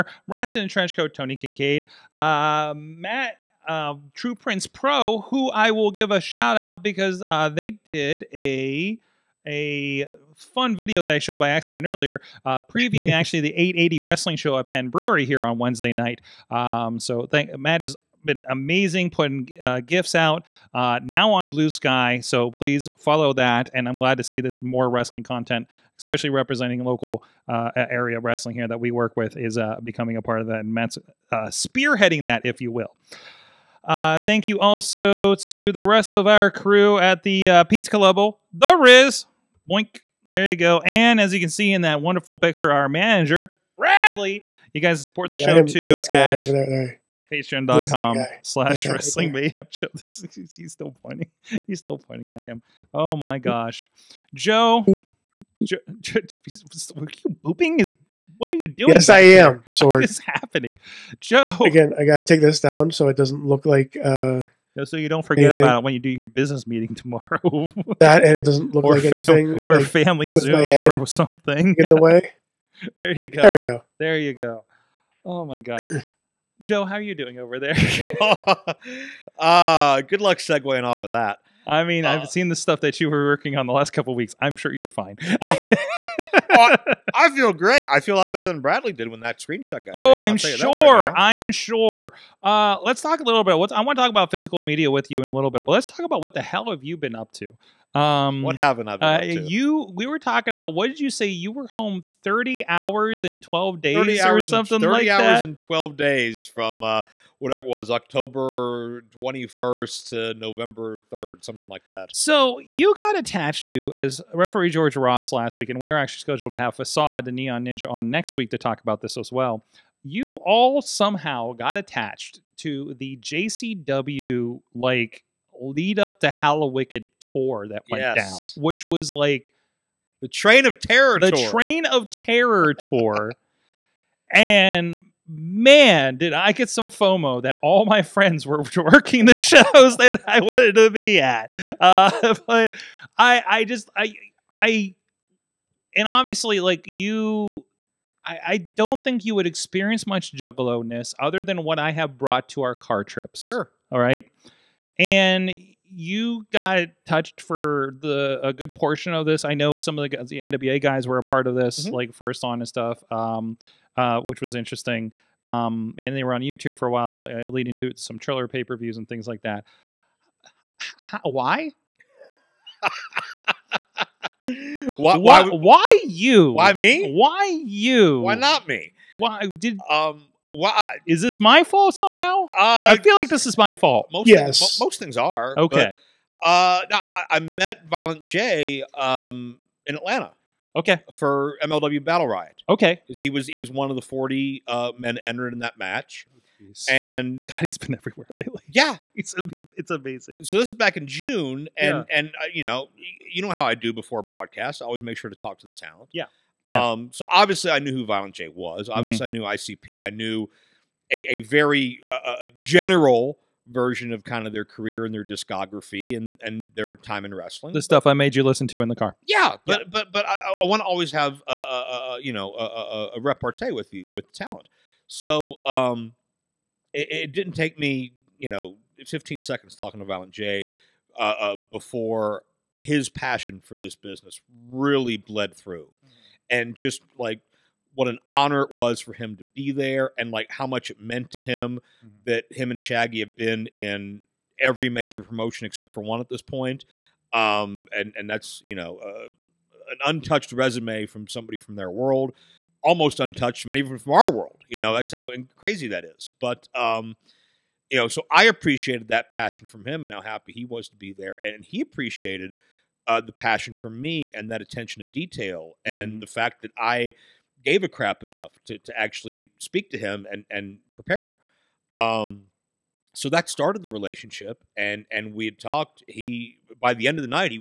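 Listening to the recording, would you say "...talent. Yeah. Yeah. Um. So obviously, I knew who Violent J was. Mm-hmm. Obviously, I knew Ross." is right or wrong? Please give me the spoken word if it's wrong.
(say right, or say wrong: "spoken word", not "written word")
wrong: "ICP", not "Ross".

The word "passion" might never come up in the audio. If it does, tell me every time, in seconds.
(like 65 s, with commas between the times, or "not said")
233 s, 259 s, 263 s.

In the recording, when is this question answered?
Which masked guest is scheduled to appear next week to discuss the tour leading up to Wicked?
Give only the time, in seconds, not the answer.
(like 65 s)
116 s.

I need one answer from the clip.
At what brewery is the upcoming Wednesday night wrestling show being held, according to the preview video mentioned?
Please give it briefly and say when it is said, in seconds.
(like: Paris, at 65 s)
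Penn Brewery, at 14 s.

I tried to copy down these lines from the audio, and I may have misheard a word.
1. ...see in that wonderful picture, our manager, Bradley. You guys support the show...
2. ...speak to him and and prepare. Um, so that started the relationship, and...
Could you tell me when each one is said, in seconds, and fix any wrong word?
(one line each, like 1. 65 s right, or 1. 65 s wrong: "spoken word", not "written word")
1. 41 s right
2. 269 s right.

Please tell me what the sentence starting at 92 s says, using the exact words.
Uh, let's talk a little bit.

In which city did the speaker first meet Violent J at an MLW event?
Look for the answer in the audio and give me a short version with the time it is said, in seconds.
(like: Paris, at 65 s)
Atlanta, at 189 s.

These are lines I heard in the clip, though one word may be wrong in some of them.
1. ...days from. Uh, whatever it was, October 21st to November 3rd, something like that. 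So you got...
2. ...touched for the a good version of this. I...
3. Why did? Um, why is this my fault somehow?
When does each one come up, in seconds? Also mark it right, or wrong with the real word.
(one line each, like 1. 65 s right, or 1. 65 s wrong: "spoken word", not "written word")
1. 105 s right
2. 157 s wrong: "portion", not "version"
3. 179 s right.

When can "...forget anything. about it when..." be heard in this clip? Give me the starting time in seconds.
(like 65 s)
65 s.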